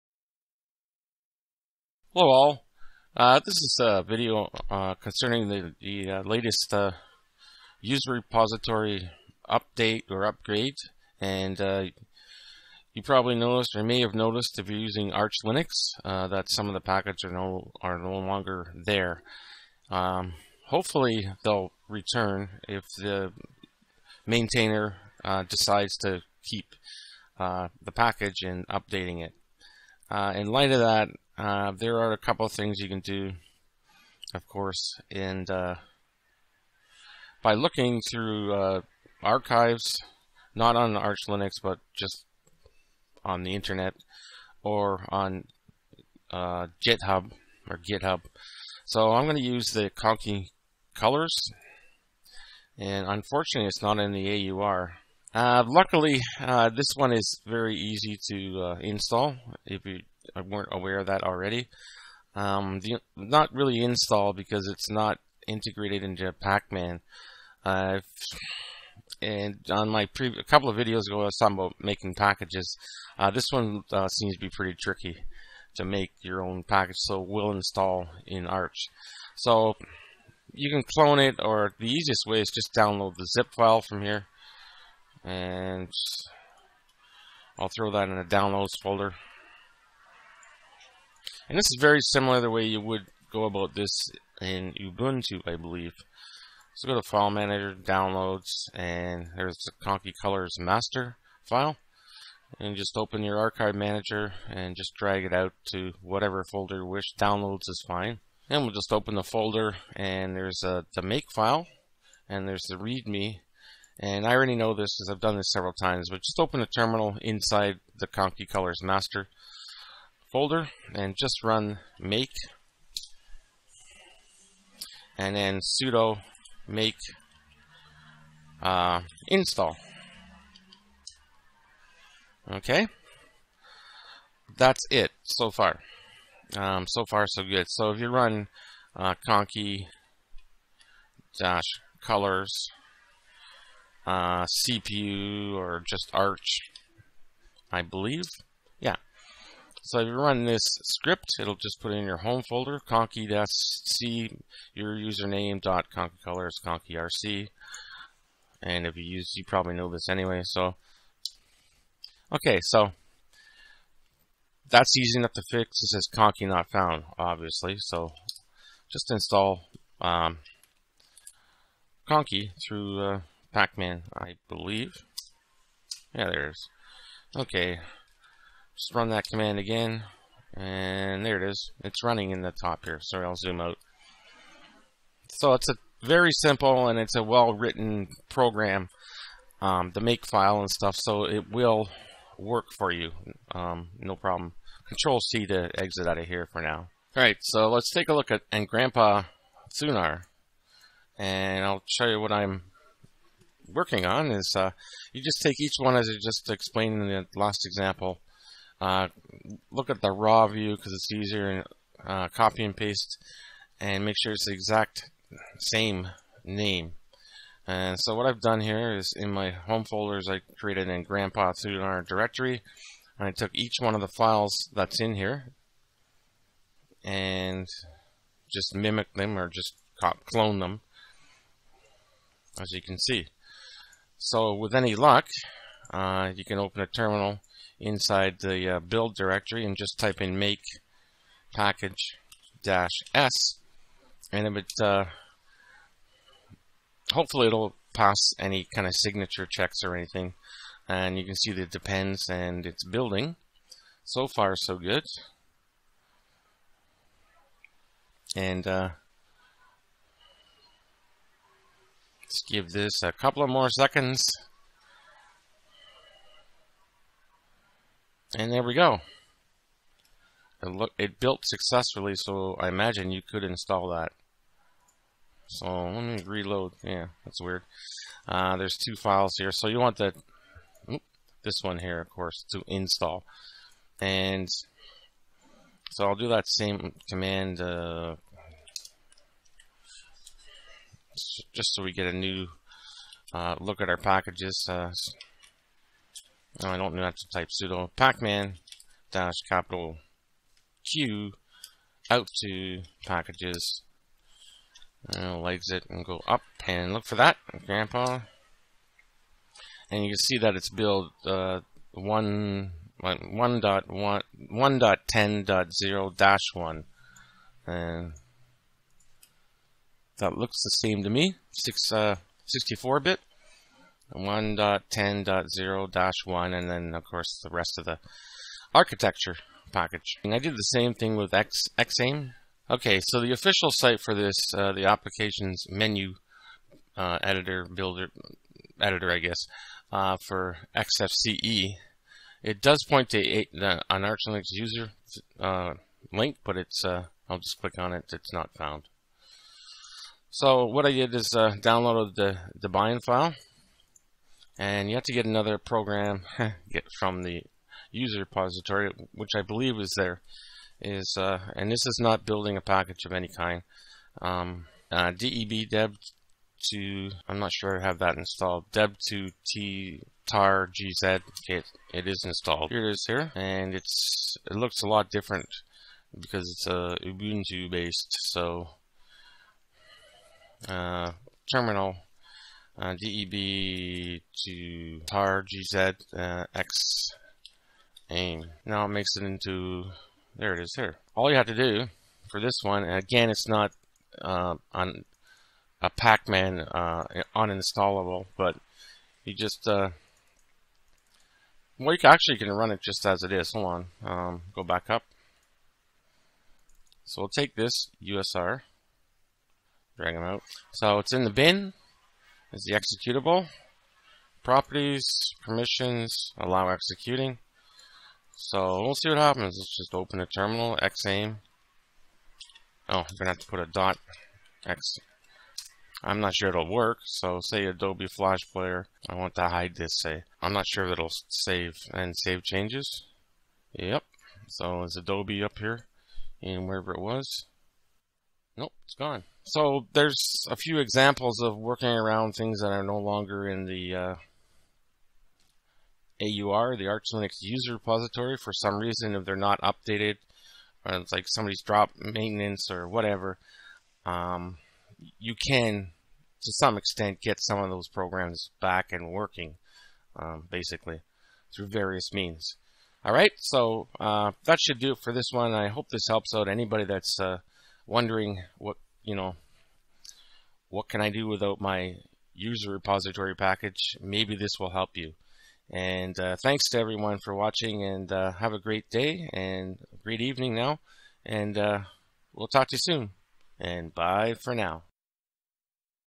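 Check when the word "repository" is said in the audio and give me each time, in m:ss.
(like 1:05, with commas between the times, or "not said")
0:08, 5:58, 7:27, 7:52.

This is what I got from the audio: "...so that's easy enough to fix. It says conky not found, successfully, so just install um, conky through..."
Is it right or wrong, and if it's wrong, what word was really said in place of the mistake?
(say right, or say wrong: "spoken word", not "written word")
wrong: "obviously", not "successfully".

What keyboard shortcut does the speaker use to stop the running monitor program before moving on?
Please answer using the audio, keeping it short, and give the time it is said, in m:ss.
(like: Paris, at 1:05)
Control C, at 3:14.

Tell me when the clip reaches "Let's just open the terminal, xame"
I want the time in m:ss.
6:59.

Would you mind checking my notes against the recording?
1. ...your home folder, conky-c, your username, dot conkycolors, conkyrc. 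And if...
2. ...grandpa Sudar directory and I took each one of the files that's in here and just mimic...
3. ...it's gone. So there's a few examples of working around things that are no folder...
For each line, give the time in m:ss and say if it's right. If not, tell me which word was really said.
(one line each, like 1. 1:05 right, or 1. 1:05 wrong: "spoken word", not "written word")
1. 2:32 right
2. 3:41 right
3. 7:18 wrong: "longer", not "folder".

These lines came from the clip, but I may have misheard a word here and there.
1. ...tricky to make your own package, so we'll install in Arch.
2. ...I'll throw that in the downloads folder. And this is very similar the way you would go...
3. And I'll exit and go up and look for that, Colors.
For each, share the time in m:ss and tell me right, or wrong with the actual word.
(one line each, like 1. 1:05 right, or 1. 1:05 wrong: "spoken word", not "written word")
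1. 1:14 right
2. 1:27 right
3. 5:05 wrong: "Grandpa", not "Colors".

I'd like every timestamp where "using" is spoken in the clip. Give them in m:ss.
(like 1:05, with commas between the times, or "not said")
0:14.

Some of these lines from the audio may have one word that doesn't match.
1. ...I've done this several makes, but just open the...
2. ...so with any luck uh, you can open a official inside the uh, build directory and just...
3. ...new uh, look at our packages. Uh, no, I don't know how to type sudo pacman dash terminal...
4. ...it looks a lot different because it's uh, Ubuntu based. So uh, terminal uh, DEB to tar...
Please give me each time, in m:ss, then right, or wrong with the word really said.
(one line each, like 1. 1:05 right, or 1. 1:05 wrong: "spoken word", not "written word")
1. 1:55 wrong: "times", not "makes"
2. 3:54 wrong: "terminal", not "official"
3. 4:52 wrong: "capital", not "terminal"
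4. 6:14 right.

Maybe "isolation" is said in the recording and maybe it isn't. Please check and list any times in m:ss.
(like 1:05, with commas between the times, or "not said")
not said.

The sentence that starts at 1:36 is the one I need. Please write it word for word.
So go to File Manager, Downloads, and there's the Conky Colors master file.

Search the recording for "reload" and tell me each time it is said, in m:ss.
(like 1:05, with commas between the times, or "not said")
4:36.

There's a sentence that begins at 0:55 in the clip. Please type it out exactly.
Uh, luckily, uh, this one is very easy to install if you I weren't aware of that already.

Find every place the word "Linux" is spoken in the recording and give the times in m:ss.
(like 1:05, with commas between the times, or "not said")
0:15, 0:41, 5:44, 7:27.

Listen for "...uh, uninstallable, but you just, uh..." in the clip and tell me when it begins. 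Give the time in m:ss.
6:36.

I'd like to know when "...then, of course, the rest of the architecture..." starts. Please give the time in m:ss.
5:26.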